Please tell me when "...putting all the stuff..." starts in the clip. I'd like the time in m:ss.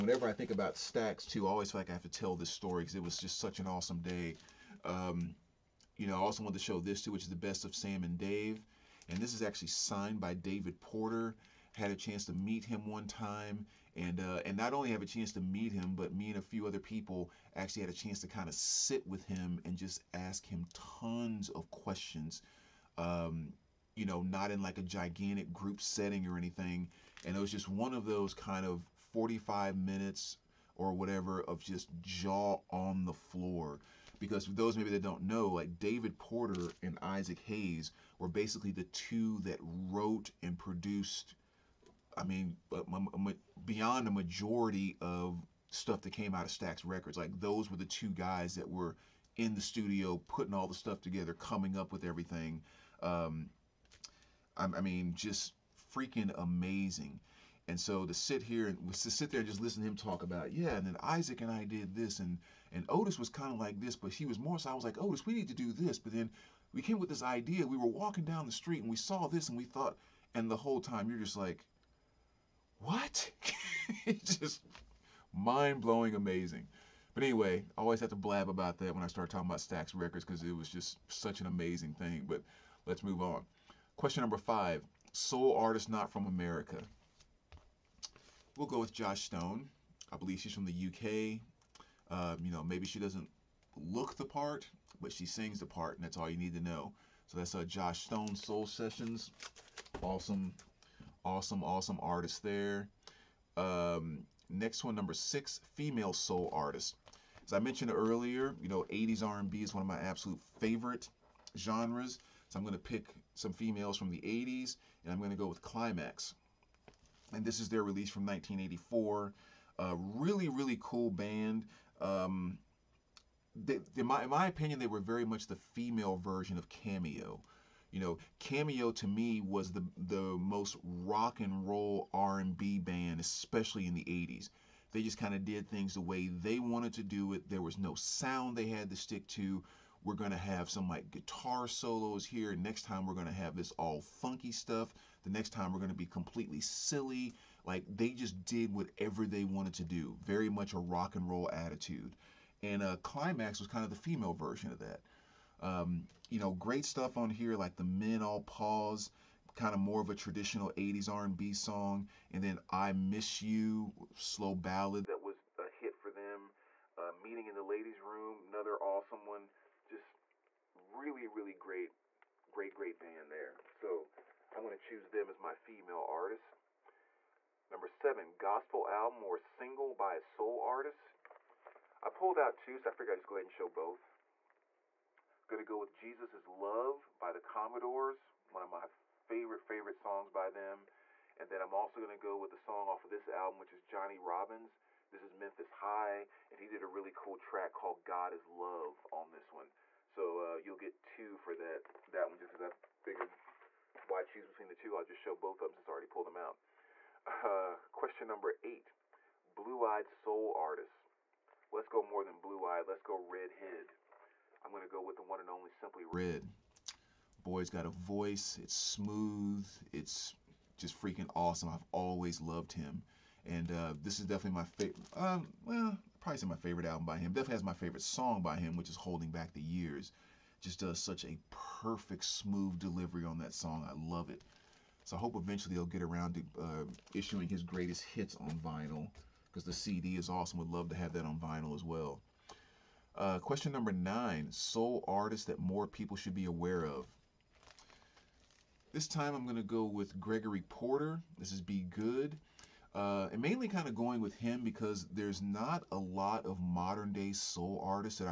0:50.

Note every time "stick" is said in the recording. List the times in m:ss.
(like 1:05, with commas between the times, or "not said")
2:18.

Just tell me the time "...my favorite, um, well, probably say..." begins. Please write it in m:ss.
3:44.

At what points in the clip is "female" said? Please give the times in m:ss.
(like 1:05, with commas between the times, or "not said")
1:45, 1:53, 2:05, 2:33, 2:55.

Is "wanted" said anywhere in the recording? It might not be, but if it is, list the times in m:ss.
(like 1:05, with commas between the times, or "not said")
0:06, 2:16, 2:29.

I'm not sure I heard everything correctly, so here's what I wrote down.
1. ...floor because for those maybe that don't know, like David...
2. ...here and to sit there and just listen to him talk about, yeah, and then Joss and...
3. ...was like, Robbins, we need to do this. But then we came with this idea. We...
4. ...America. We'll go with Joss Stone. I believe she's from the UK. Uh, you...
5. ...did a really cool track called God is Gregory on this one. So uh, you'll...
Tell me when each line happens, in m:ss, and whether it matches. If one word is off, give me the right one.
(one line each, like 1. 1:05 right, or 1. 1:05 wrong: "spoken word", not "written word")
1. 0:33 right
2. 0:58 wrong: "Isaac", not "Joss"
3. 1:04 wrong: "Otis", not "Robbins"
4. 1:26 right
5. 3:16 wrong: "Love", not "Gregory".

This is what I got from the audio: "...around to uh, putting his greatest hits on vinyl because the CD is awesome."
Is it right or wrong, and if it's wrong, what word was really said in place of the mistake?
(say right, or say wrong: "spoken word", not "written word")
wrong: "issuing", not "putting".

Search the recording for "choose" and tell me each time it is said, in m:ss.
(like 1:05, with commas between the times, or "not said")
2:54, 3:24.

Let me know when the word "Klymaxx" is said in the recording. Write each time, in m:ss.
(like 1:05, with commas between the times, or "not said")
1:55, 2:33.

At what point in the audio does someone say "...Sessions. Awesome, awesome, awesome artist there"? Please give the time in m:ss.
1:38.